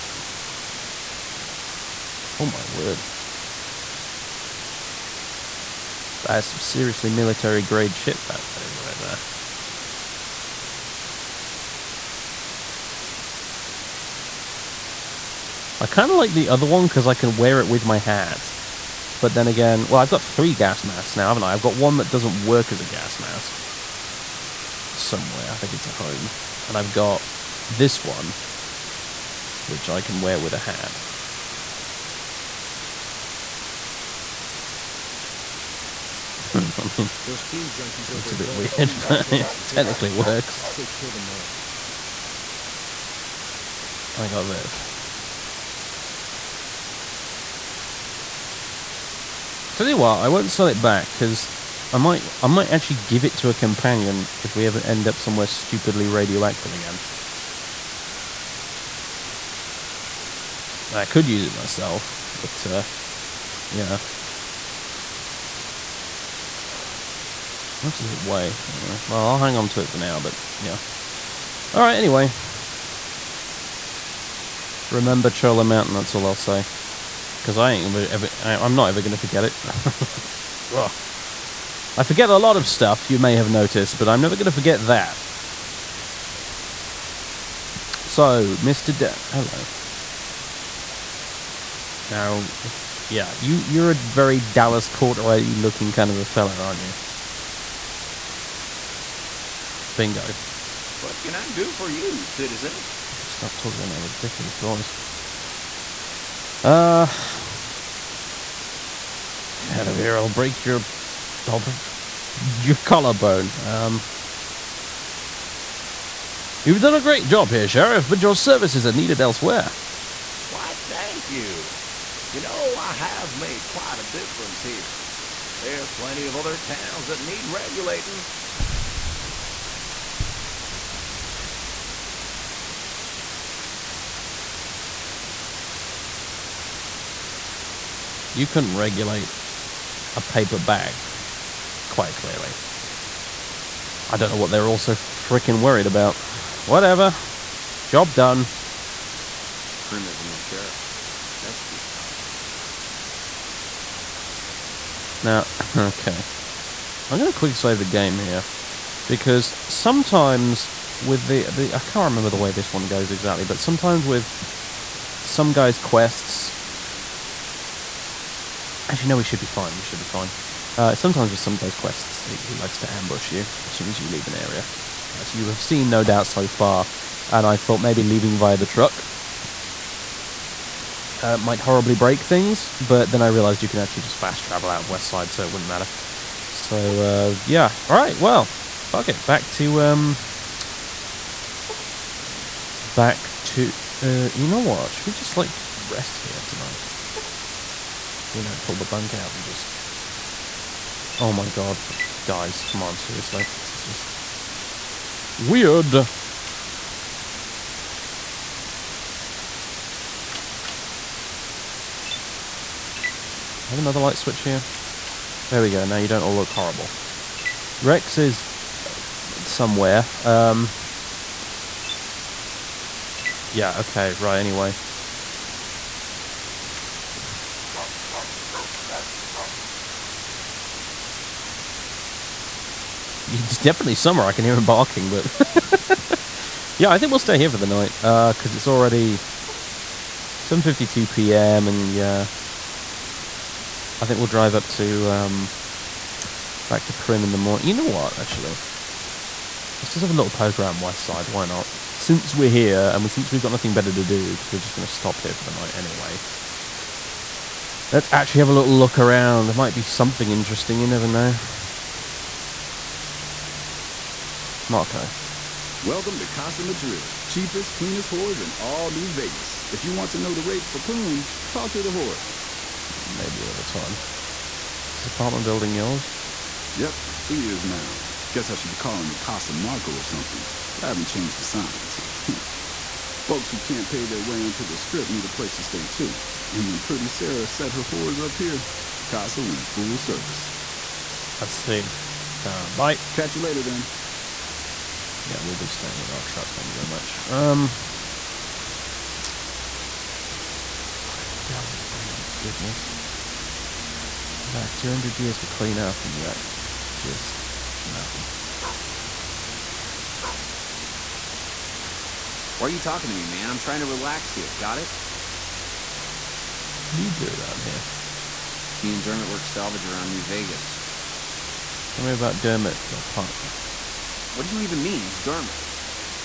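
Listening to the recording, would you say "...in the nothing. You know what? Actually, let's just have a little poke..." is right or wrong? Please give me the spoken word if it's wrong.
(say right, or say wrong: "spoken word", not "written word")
wrong: "morning", not "nothing".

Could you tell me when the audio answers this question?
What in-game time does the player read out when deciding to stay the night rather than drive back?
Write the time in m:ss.
4:00.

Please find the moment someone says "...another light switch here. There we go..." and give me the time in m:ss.
3:33.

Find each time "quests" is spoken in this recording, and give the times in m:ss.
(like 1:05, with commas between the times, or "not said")
2:45, 2:51.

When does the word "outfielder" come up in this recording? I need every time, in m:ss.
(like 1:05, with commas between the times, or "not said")
not said.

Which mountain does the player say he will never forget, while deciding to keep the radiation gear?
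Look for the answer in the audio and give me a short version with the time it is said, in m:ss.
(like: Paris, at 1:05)
Chola Mountain, at 1:15.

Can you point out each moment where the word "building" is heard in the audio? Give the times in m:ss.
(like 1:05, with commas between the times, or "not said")
4:35.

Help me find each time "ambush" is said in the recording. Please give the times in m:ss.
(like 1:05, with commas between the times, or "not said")
2:52.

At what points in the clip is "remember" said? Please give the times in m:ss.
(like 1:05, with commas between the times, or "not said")
1:14, 2:42.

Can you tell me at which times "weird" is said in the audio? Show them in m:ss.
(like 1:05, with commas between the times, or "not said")
0:38, 3:25.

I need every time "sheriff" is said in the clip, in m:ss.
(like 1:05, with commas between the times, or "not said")
1:57, 2:30.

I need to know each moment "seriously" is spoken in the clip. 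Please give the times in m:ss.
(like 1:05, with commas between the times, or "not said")
0:06, 3:22.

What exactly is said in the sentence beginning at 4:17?
Let's actually have a little look around.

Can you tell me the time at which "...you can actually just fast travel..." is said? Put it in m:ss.
3:03.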